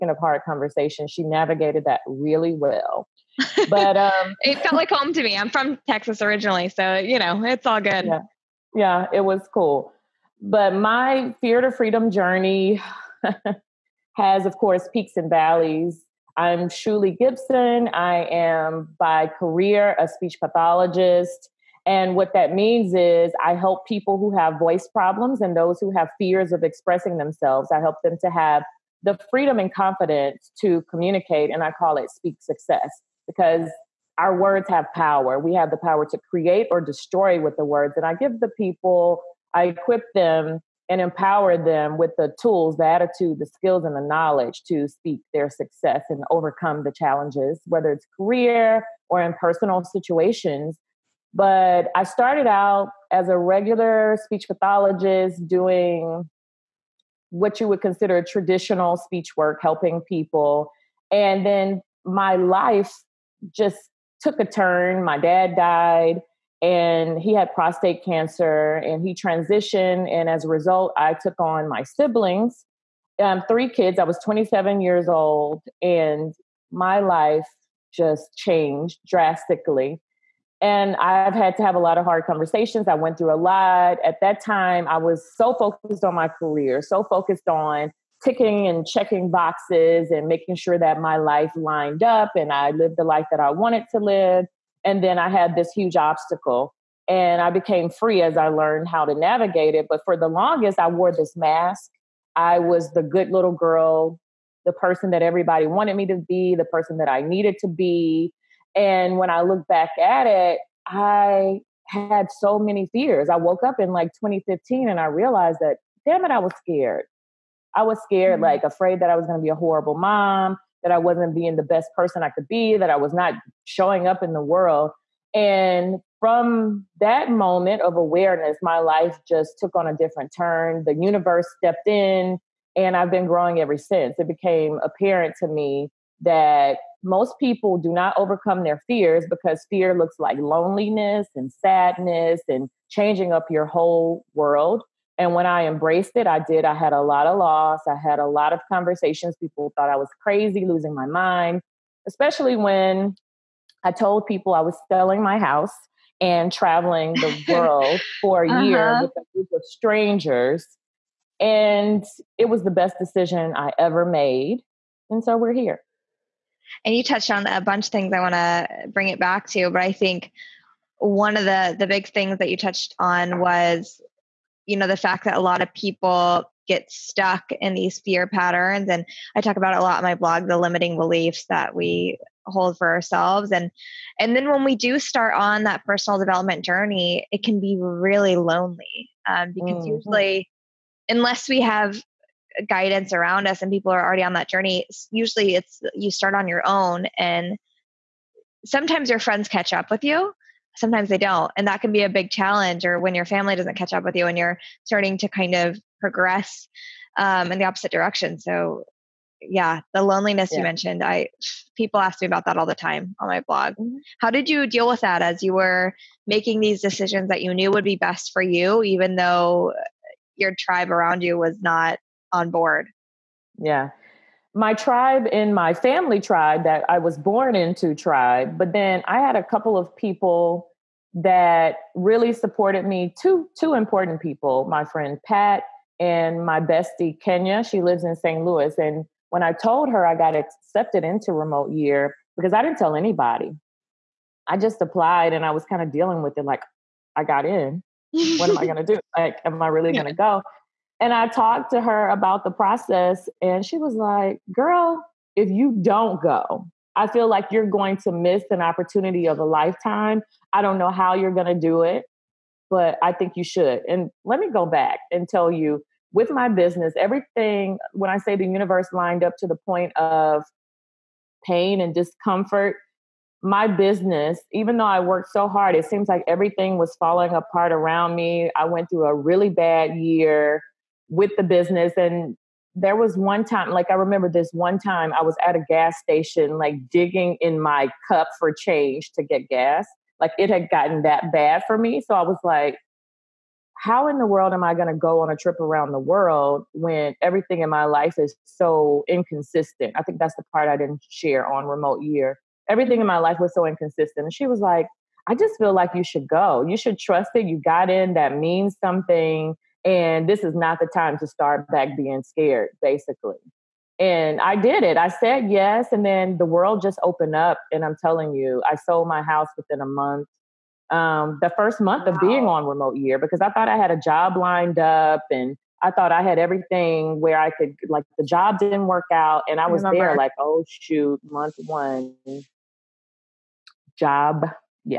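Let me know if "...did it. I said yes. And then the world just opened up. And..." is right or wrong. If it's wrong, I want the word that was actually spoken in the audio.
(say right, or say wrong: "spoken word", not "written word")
right.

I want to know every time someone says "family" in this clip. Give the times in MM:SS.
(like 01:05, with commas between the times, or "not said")
03:23, 03:45.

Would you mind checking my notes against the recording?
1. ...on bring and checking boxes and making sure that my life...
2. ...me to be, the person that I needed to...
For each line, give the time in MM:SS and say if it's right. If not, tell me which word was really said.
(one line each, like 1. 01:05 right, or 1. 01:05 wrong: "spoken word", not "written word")
1. 01:27 wrong: "ticking", not "bring"
2. 01:45 right.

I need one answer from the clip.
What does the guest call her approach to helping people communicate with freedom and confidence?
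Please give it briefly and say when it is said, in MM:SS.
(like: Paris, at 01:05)
Speak success, at 00:32.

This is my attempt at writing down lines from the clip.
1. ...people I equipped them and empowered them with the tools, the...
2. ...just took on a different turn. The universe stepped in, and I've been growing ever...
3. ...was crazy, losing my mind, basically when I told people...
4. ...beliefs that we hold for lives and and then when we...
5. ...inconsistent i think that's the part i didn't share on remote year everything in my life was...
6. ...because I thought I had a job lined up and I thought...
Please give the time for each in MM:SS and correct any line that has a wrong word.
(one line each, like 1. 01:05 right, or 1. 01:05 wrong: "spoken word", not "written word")
1. 00:38 right
2. 02:09 right
3. 02:29 wrong: "especially", not "basically"
4. 03:00 wrong: "ourselves", not "lives"
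5. 04:59 right
6. 05:23 right.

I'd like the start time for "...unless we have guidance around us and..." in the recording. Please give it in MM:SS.
03:11.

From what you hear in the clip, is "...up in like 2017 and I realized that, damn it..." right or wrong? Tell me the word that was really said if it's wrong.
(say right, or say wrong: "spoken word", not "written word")
wrong: "2015", not "2017".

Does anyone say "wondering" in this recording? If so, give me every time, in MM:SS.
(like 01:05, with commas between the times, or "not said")
not said.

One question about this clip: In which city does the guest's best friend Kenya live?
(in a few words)
St. Louis.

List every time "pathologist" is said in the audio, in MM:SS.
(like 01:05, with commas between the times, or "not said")
00:20, 00:54.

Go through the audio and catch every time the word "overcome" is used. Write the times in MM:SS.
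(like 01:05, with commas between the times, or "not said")
00:46, 02:18.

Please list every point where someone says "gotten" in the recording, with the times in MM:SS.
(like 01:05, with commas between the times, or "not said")
04:50.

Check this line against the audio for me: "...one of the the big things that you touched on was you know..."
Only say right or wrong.
right.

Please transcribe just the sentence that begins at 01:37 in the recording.
And I became free as I learned how to navigate it.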